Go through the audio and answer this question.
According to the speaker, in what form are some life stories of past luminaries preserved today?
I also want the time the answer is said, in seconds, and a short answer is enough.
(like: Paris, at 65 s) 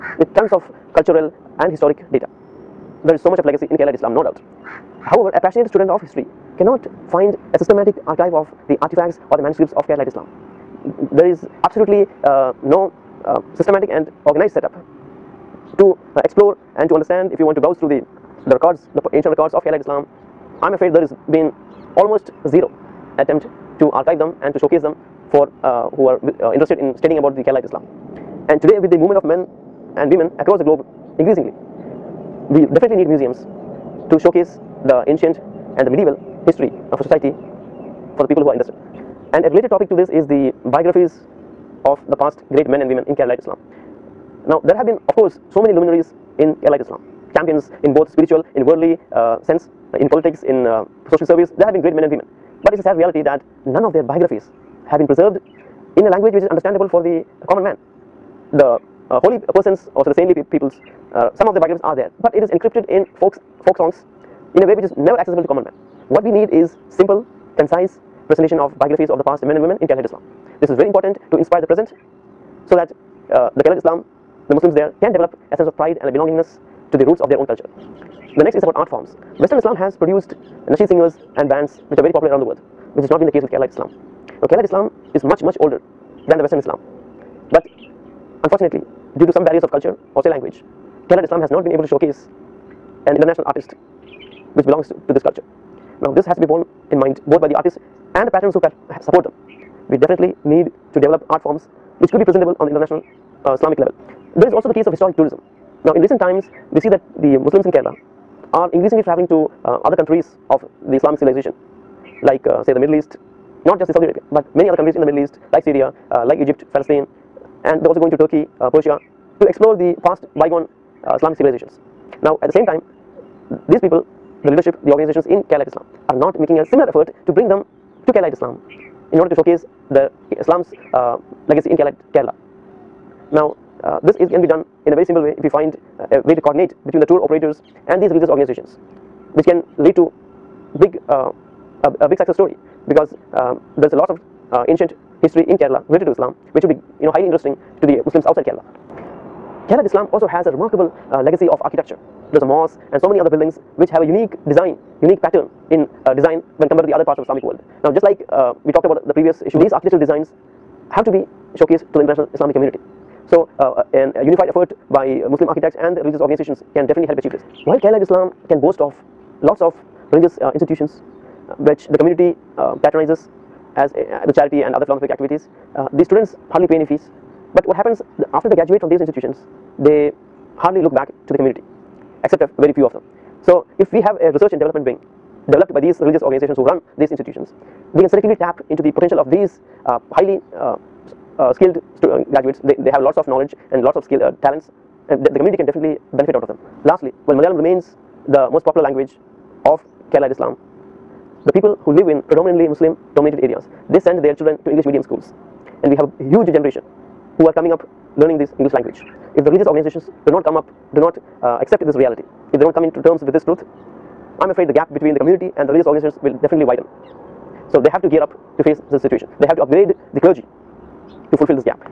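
Folk songs, at 63 s.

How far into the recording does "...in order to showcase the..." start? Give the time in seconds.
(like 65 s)
129 s.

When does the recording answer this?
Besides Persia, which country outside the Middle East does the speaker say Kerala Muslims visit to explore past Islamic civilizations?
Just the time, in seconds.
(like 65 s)
118 s.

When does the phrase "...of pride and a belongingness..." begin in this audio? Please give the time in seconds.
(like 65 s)
75 s.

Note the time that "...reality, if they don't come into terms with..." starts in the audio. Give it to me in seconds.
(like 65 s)
211 s.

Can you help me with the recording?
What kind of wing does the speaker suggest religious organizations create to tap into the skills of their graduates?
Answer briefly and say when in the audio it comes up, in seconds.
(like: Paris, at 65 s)
Research and development, at 184 s.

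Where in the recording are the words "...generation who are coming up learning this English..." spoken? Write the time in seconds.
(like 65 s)
206 s.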